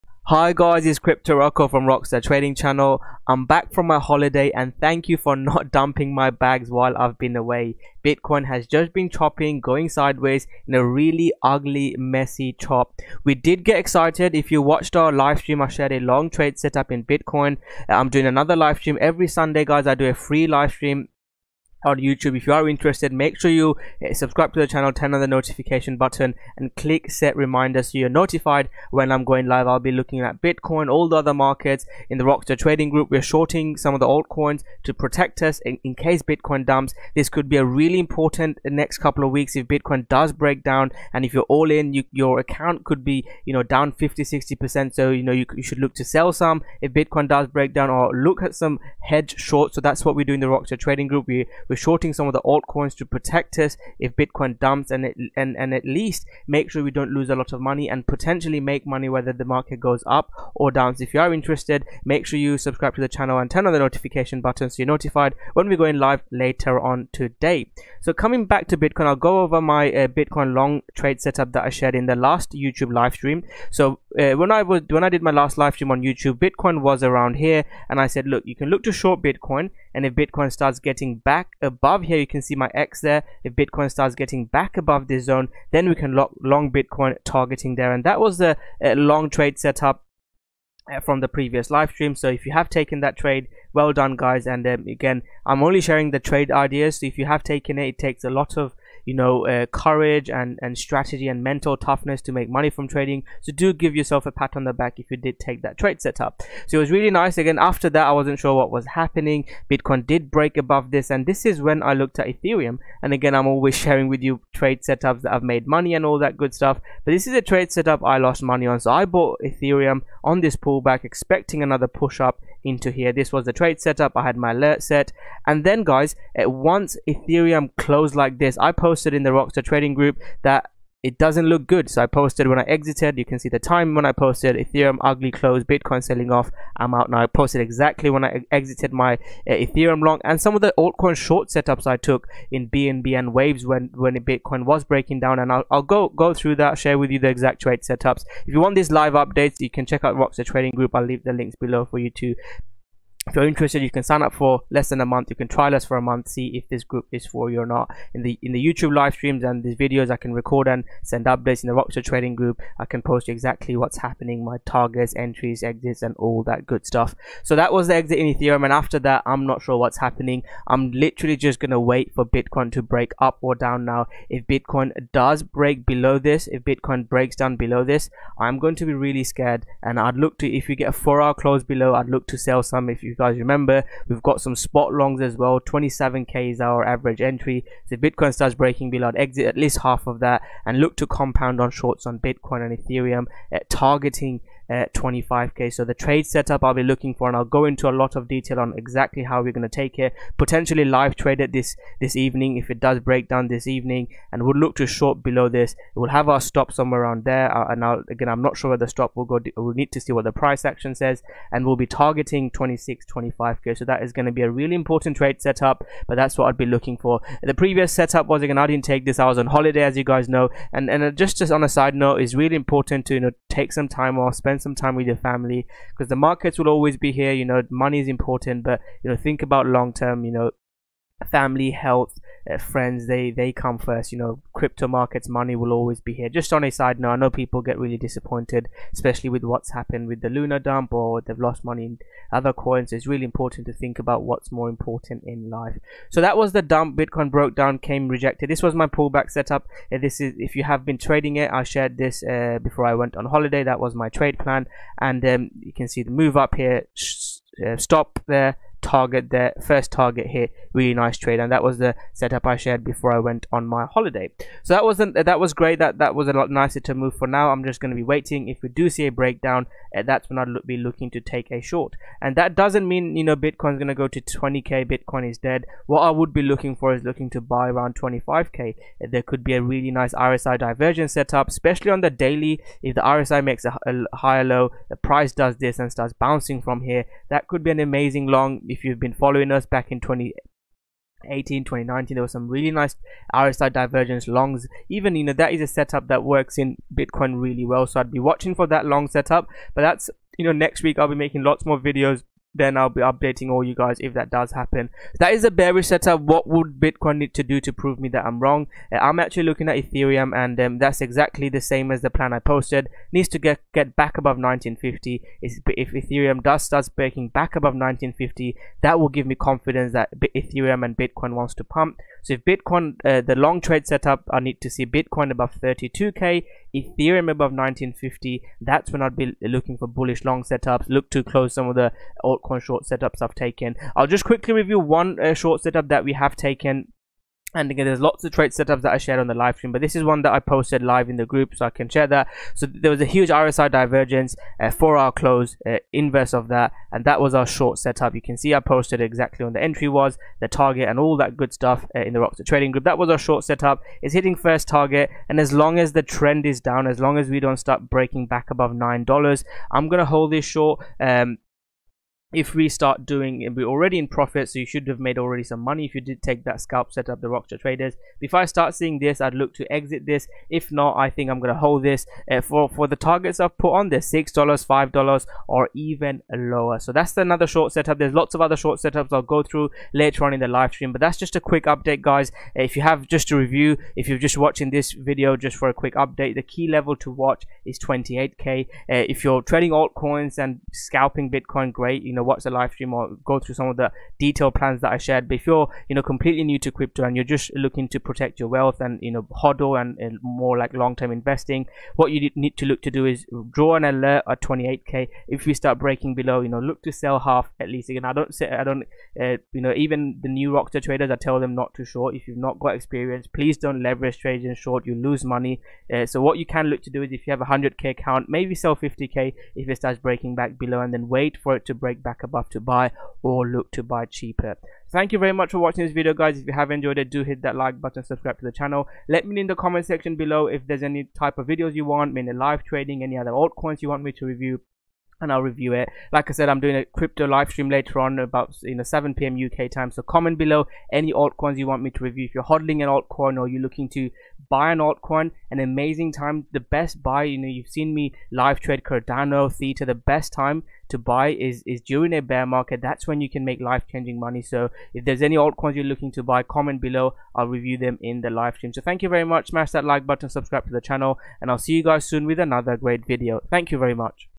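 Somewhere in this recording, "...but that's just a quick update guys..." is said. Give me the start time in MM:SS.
06:20.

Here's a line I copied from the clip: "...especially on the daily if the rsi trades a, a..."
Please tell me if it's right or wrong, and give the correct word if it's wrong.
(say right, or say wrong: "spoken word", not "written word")
wrong: "makes", not "trades".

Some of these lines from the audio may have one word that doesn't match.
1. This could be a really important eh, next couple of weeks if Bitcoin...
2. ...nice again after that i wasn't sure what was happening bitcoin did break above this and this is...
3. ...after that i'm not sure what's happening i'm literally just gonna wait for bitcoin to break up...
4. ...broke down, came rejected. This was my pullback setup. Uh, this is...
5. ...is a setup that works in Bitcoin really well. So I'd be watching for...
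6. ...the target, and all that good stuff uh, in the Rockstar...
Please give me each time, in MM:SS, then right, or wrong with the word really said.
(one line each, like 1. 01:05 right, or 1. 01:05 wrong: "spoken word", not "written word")
1. 00:37 right
2. 01:47 right
3. 02:48 right
4. 04:07 right
5. 04:55 right
6. 05:50 right.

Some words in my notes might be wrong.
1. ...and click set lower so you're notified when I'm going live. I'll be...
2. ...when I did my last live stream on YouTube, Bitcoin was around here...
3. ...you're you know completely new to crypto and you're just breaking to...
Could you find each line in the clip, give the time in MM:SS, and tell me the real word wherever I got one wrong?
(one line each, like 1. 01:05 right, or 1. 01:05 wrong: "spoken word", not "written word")
1. 00:26 wrong: "reminder", not "lower"
2. 01:14 right
3. 06:35 wrong: "looking", not "breaking".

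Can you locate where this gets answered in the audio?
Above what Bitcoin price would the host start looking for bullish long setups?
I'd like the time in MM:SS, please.
05:25.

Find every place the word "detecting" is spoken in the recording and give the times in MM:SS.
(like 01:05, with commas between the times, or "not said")
not said.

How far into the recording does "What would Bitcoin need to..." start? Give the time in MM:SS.
05:06.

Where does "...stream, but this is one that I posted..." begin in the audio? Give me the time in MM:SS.
05:39.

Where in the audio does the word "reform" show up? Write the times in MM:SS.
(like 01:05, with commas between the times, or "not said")
not said.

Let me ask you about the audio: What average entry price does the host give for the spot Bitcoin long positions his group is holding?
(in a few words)
27k.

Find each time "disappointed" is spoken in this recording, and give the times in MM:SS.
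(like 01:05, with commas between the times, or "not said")
03:57.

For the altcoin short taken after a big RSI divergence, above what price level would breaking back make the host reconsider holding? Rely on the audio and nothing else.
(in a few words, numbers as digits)
$9.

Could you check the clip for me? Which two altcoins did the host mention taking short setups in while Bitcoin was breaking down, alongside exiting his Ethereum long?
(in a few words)
BNB and Waves.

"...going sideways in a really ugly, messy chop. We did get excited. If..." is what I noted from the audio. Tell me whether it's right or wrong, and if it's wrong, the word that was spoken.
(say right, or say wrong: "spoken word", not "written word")
right.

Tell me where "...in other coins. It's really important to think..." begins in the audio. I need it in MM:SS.
04:01.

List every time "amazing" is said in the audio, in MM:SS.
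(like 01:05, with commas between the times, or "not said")
04:47, 07:25.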